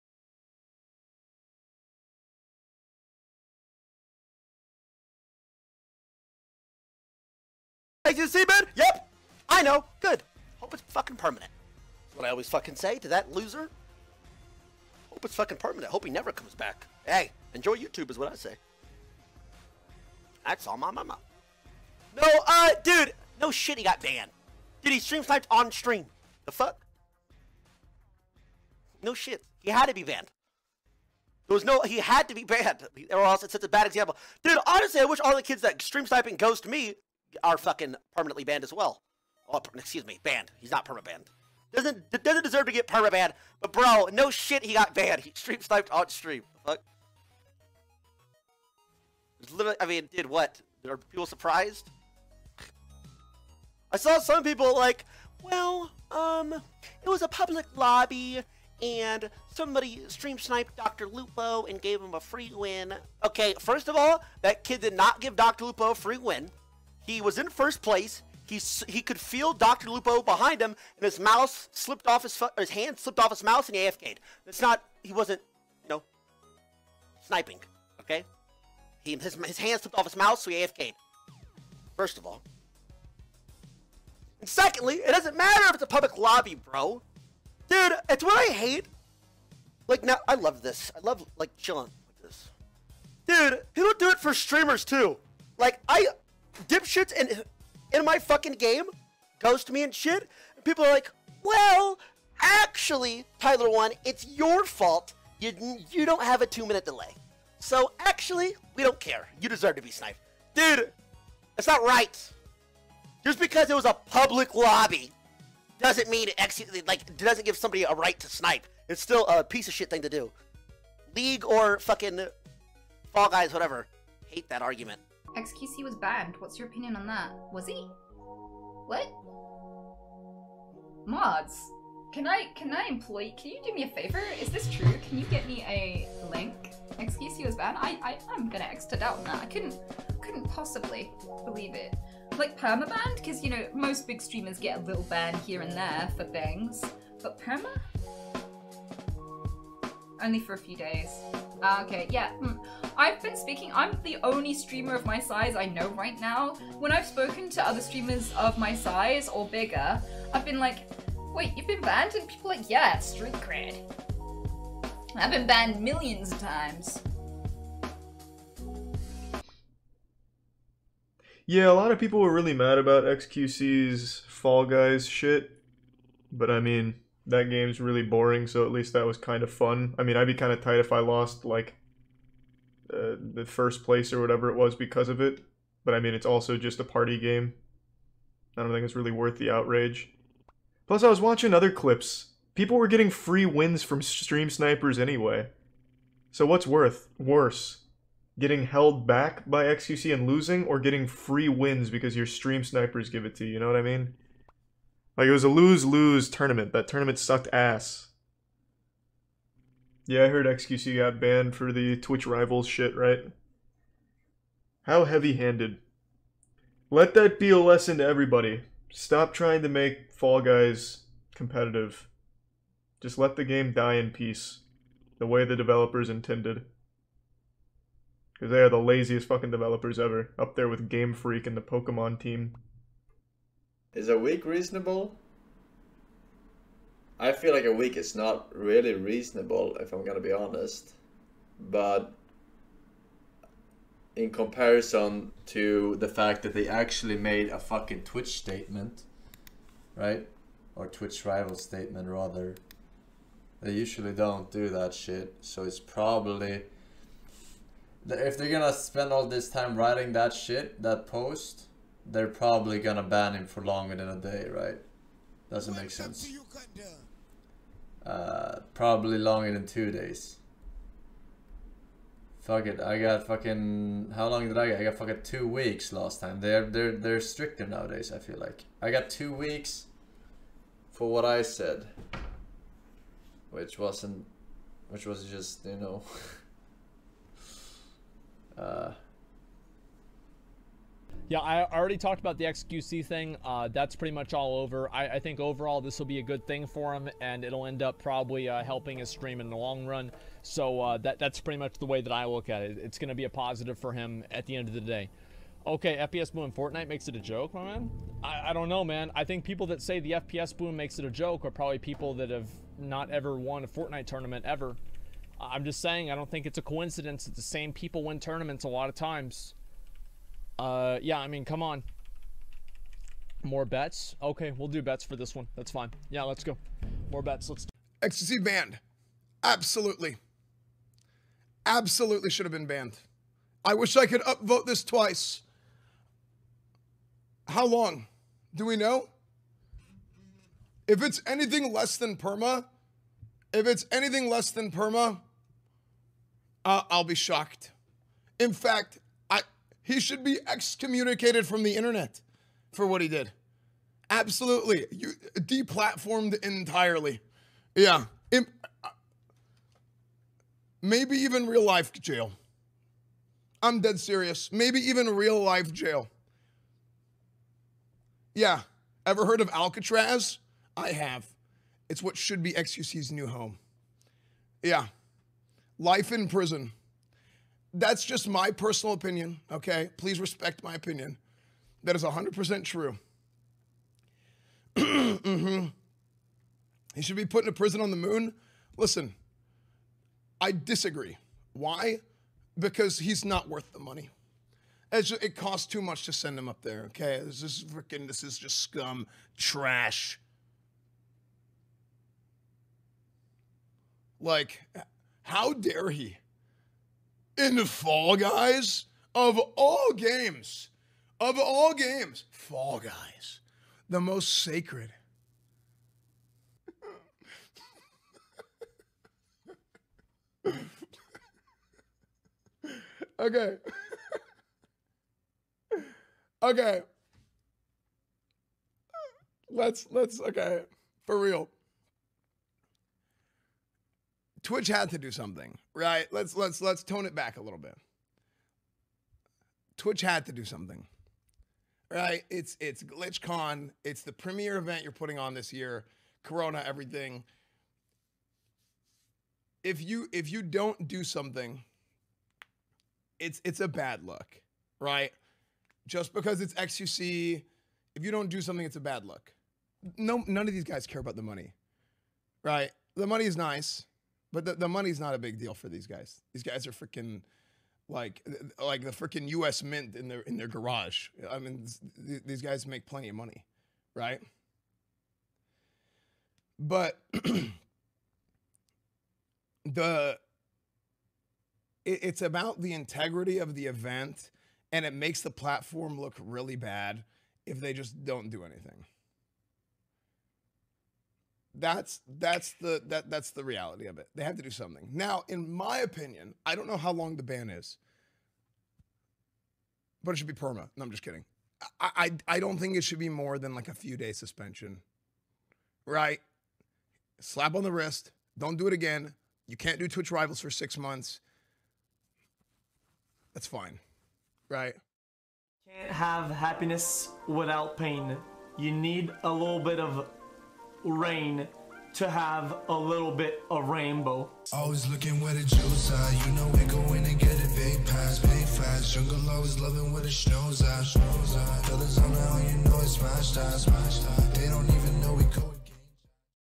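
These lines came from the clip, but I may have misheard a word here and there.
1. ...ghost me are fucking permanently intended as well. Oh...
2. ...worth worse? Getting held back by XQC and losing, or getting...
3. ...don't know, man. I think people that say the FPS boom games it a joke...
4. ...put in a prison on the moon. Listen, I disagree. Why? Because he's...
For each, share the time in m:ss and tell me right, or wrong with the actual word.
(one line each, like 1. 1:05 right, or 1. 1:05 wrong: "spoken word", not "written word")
1. 0:36 wrong: "banned", not "intended"
2. 3:16 right
3. 5:08 wrong: "makes", not "games"
4. 6:27 right.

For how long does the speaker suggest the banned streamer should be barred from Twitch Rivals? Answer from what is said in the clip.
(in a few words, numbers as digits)
6 months.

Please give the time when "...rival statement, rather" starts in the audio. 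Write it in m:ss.
4:11.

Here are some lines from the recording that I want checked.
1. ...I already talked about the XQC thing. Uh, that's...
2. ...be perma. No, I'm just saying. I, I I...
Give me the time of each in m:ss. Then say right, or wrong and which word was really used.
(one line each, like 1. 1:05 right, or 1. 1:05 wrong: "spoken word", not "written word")
1. 4:51 right
2. 8:20 wrong: "kidding", not "saying".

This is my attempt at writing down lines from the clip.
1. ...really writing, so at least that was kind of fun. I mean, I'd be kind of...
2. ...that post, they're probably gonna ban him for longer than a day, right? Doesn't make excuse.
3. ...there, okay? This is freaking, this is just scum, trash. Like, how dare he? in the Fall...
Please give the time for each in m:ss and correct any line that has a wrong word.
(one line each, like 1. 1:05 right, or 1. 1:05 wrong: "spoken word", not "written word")
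1. 2:57 wrong: "boring", not "writing"
2. 4:20 wrong: "sense", not "excuse"
3. 6:36 right.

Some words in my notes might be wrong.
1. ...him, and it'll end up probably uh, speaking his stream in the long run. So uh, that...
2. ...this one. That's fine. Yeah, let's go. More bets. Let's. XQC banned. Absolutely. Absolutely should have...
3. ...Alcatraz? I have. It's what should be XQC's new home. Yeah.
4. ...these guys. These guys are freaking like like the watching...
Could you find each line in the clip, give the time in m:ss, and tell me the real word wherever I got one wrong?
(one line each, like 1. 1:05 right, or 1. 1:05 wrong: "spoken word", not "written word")
1. 4:56 wrong: "helping", not "speaking"
2. 5:25 right
3. 6:09 right
4. 7:45 wrong: "freaking", not "watching".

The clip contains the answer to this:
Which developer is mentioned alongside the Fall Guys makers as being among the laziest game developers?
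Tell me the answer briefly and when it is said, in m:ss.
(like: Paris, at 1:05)
Game Freak, at 3:50.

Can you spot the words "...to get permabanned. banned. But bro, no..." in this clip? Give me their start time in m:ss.
0:42.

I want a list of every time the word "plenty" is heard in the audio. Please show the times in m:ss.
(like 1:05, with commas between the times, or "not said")
7:52.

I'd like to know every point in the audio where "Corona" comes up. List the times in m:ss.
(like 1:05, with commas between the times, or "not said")
7:26.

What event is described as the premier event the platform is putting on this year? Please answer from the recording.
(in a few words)
GlitchCon.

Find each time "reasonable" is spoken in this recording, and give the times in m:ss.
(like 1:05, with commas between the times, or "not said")
3:54, 3:58.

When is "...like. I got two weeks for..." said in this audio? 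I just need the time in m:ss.
4:38.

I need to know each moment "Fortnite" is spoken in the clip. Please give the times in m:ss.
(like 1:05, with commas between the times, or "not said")
5:06, 5:13.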